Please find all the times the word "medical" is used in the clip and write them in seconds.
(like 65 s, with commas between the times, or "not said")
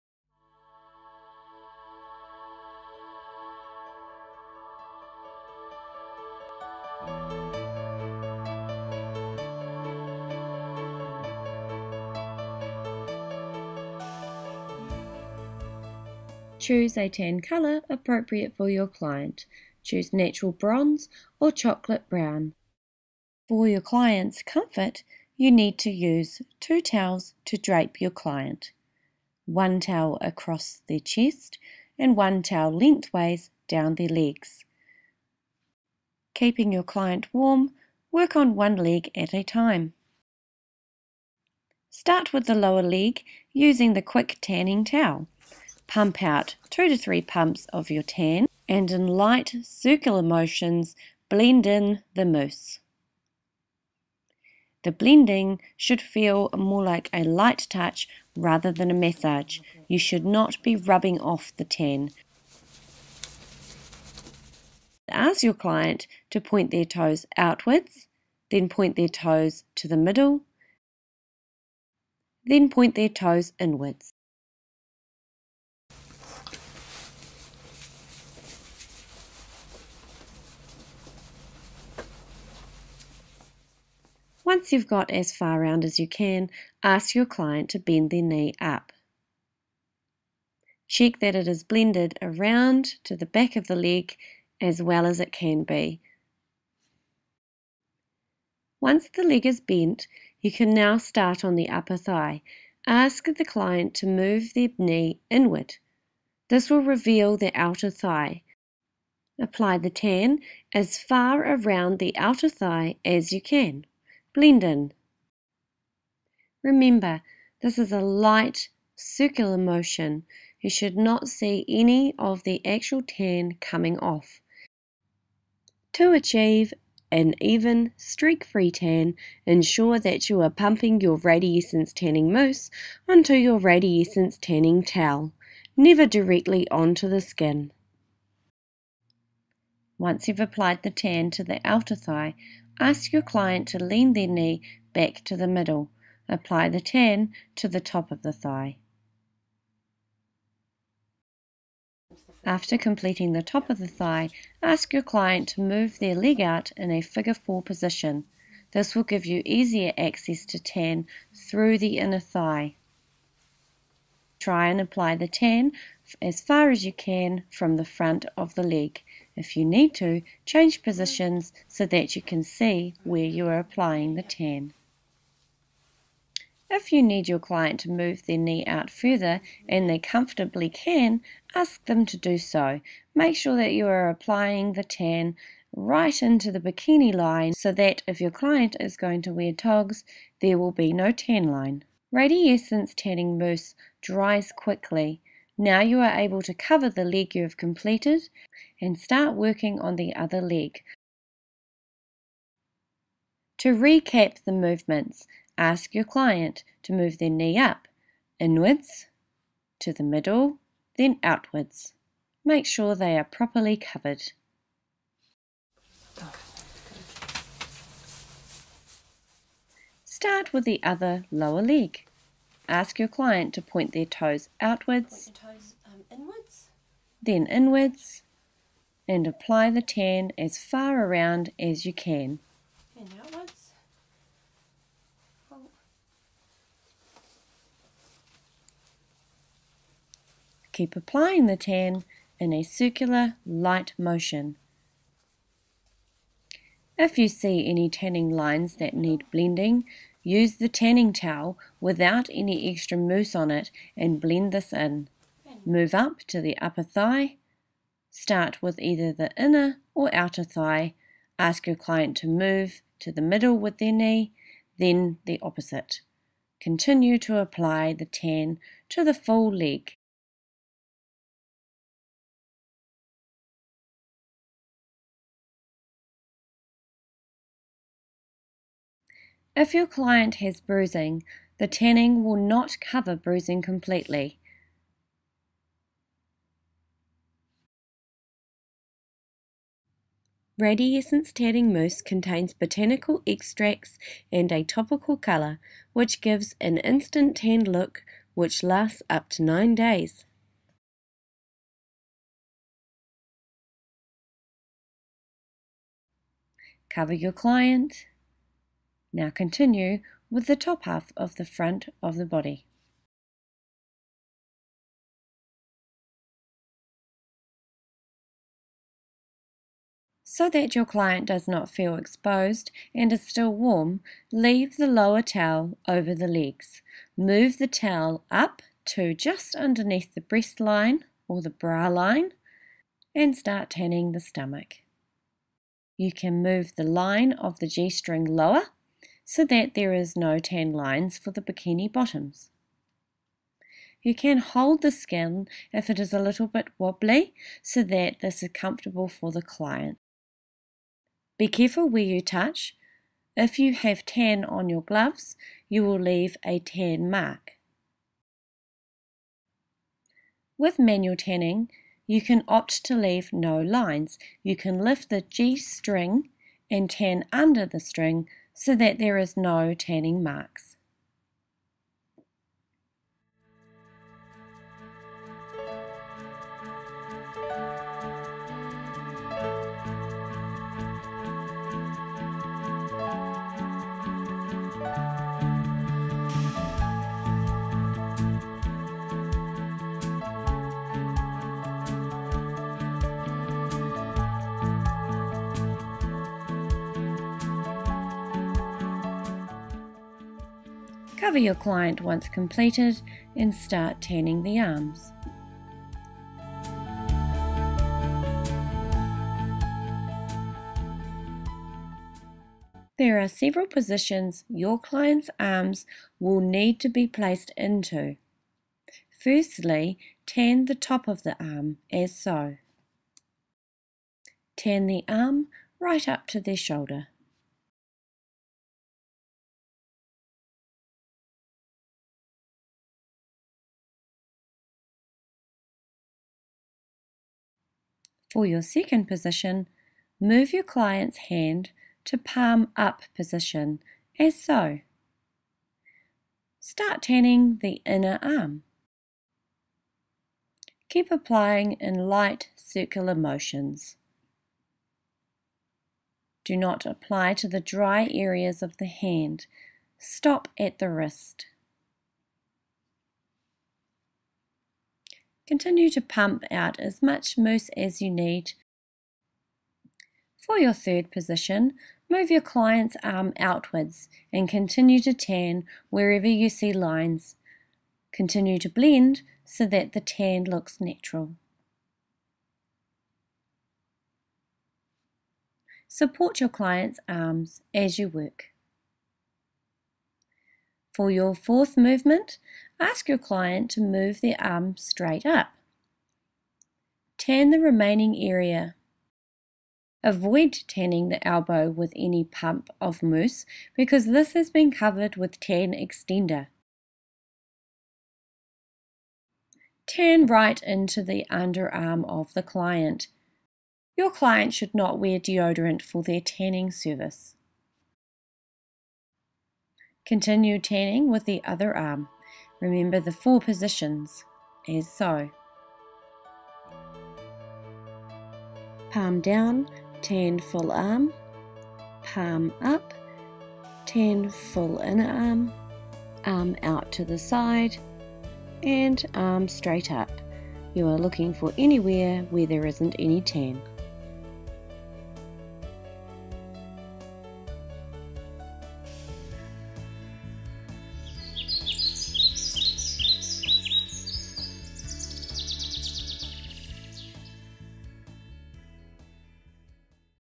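not said.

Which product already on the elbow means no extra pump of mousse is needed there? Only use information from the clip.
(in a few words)
tan extender.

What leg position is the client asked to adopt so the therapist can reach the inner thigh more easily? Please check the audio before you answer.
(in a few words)
figure four position.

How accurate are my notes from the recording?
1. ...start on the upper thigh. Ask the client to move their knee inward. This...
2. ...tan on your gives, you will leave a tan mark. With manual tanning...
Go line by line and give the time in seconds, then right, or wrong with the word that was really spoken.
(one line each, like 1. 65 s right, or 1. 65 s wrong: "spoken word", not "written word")
1. 100 s right
2. 354 s wrong: "gloves", not "gives".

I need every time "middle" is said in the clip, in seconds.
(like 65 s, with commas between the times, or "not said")
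69 s, 145 s, 210 s, 263 s.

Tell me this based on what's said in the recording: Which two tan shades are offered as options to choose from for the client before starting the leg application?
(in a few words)
natural bronze or chocolate brown.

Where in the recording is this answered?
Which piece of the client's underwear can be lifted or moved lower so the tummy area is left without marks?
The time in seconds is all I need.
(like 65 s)
337 s.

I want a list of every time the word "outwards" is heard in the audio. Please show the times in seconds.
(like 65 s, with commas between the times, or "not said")
67 s, 211 s, 224 s, 473 s.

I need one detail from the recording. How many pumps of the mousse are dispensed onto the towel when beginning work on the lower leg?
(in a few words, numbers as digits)
2 to 3.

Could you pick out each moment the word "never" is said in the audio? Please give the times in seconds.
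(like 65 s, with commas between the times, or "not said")
135 s.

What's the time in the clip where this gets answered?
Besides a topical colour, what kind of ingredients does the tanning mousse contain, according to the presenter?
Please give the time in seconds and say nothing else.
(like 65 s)
292 s.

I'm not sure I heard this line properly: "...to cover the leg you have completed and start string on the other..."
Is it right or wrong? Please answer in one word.
wrong.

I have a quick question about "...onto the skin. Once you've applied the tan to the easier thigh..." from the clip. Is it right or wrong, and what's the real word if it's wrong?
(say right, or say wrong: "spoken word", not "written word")
wrong: "outer", not "easier".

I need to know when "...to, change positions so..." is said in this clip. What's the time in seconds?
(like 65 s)
169 s.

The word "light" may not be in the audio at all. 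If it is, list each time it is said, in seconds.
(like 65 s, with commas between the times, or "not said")
49 s, 57 s, 117 s, 243 s, 452 s.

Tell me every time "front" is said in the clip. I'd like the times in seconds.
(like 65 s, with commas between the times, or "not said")
167 s, 311 s.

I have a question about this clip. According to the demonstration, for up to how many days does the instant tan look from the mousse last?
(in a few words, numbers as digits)
9 days.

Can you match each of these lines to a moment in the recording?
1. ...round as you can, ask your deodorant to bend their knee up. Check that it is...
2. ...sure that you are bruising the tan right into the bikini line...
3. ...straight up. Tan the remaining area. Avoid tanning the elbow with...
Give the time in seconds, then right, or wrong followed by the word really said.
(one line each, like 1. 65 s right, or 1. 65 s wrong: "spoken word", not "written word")
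1. 85 s wrong: "client", not "deodorant"
2. 183 s wrong: "applying", not "bruising"
3. 494 s right.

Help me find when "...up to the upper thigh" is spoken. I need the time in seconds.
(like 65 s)
255 s.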